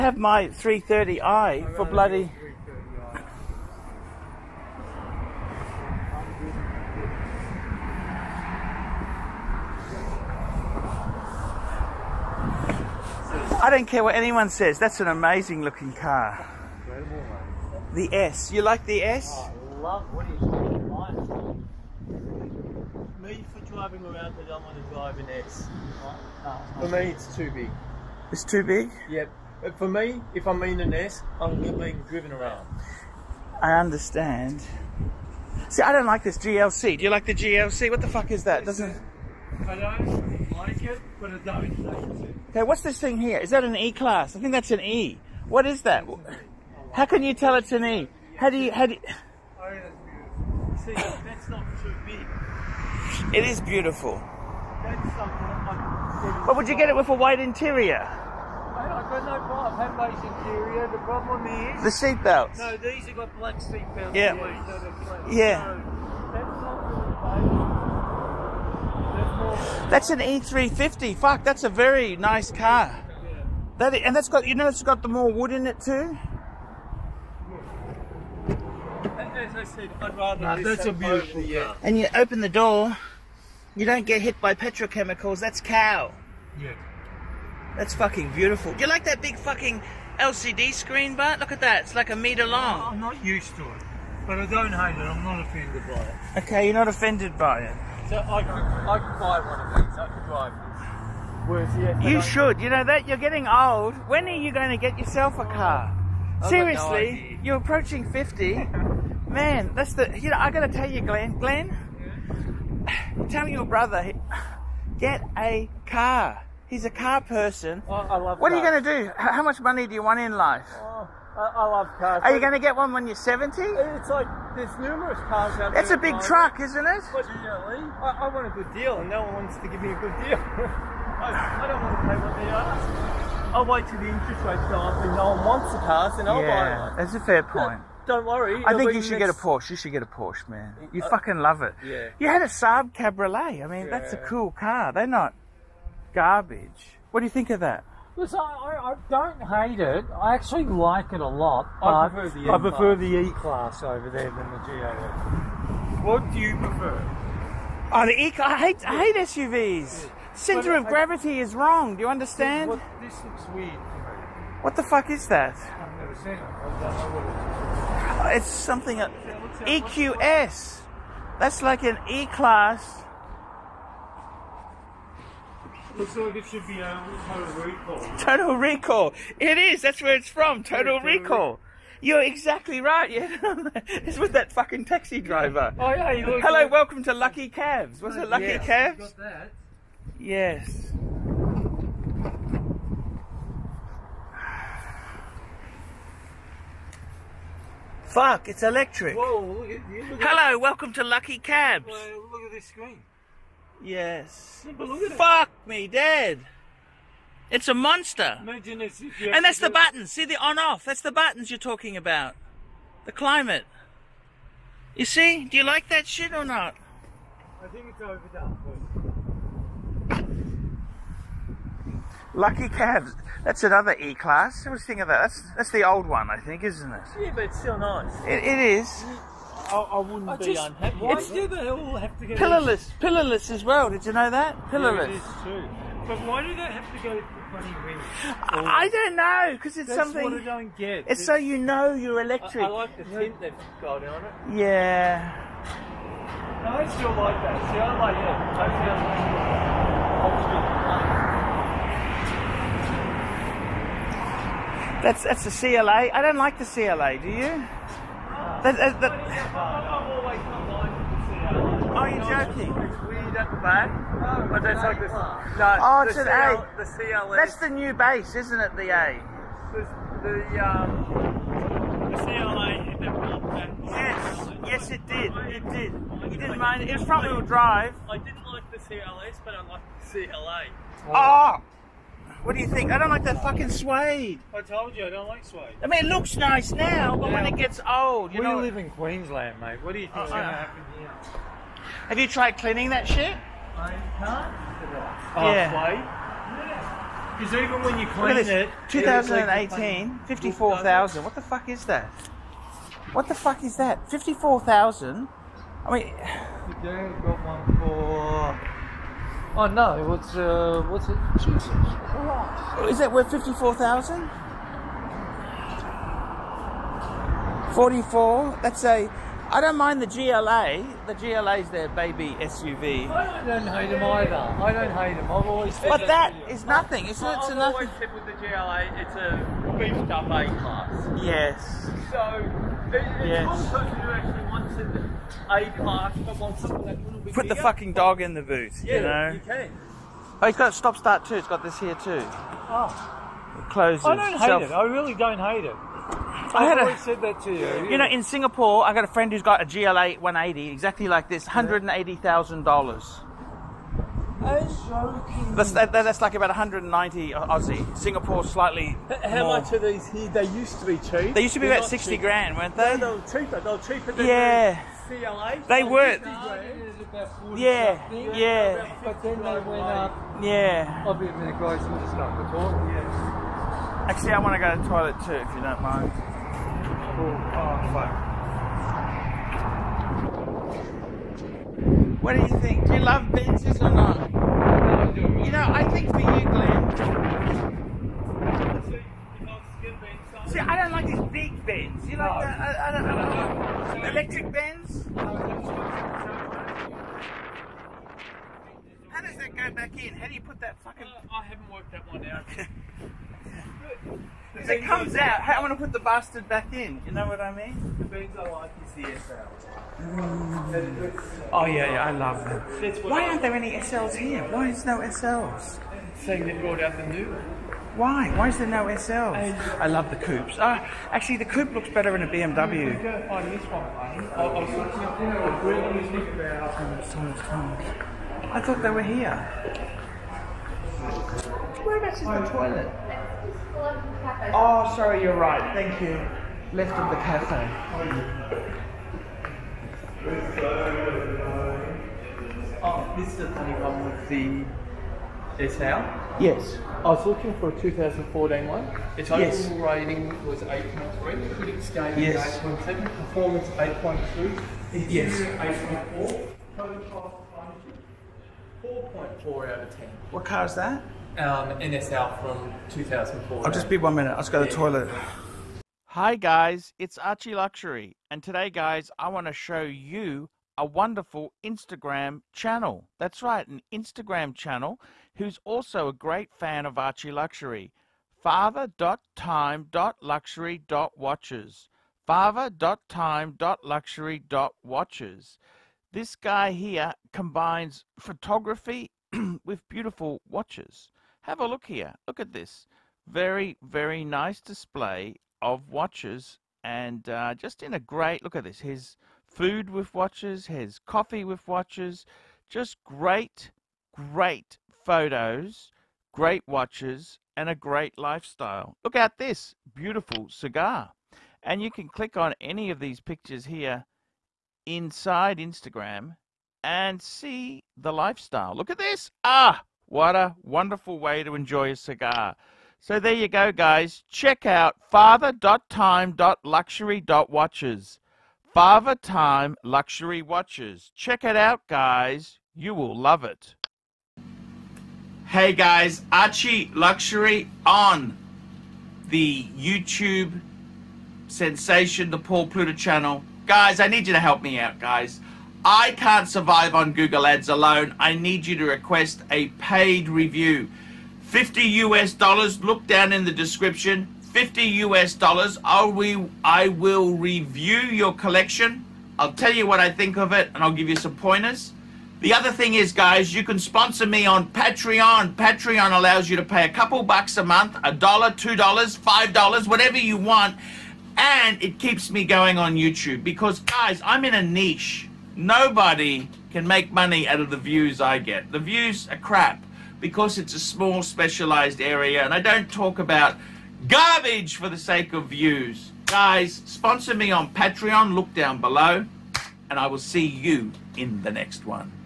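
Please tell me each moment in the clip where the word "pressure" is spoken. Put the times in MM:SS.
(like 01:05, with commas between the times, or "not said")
not said.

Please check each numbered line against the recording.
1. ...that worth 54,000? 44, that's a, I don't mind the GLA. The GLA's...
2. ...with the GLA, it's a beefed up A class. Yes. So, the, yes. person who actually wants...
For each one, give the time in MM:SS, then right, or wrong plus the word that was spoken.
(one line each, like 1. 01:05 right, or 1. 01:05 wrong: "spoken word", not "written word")
1. 05:12 right
2. 05:28 right.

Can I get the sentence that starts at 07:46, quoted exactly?
Hi guys, it's Archie Luxury, and today, guys, I want to show you a wonderful Instagram channel.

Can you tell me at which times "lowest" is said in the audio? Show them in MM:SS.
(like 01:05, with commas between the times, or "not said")
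not said.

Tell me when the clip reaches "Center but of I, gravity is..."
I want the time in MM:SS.
02:40.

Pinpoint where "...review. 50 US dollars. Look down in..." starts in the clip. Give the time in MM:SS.
09:10.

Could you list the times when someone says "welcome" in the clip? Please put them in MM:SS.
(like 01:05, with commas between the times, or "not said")
03:06, 03:20.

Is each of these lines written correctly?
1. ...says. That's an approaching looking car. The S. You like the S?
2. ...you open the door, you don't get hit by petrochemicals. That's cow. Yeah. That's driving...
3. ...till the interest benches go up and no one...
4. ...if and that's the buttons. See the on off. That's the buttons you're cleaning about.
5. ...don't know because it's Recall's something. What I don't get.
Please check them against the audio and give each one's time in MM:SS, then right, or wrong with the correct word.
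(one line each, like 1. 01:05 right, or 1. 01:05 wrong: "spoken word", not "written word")
1. 00:14 wrong: "amazing", not "approaching"
2. 01:21 wrong: "fucking", not "driving"
3. 02:13 wrong: "rates", not "benches"
4. 03:29 wrong: "talking", not "cleaning"
5. 03:58 wrong: "That", not "Recall".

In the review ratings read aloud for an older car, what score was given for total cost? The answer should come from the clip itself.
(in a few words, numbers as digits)
4.4 out of 10.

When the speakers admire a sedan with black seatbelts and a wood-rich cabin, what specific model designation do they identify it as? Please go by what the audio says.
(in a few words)
E350.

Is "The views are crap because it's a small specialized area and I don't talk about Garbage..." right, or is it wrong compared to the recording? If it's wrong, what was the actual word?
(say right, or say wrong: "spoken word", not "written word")
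right.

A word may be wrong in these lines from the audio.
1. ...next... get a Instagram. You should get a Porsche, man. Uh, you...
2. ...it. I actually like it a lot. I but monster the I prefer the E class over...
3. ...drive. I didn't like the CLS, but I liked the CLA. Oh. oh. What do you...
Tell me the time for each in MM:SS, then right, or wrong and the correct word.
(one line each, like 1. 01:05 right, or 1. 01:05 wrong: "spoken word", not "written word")
1. 02:19 wrong: "Porsche", not "Instagram"
2. 02:29 wrong: "prefer", not "monster"
3. 04:37 right.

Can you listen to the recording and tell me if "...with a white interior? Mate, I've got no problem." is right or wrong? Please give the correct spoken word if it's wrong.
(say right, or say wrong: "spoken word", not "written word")
right.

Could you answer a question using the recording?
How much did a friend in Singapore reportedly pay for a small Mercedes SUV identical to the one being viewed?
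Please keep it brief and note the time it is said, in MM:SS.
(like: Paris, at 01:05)
180,000 dollars, at 05:51.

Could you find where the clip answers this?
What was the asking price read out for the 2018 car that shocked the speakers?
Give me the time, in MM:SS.
04:58.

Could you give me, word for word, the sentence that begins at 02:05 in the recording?
It's a big truck, isn't it?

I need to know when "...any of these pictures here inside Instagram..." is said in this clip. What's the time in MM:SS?
08:32.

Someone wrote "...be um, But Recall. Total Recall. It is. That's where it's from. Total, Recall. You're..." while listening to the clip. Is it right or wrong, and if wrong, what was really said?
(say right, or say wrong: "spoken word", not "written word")
wrong: "Total", not "But".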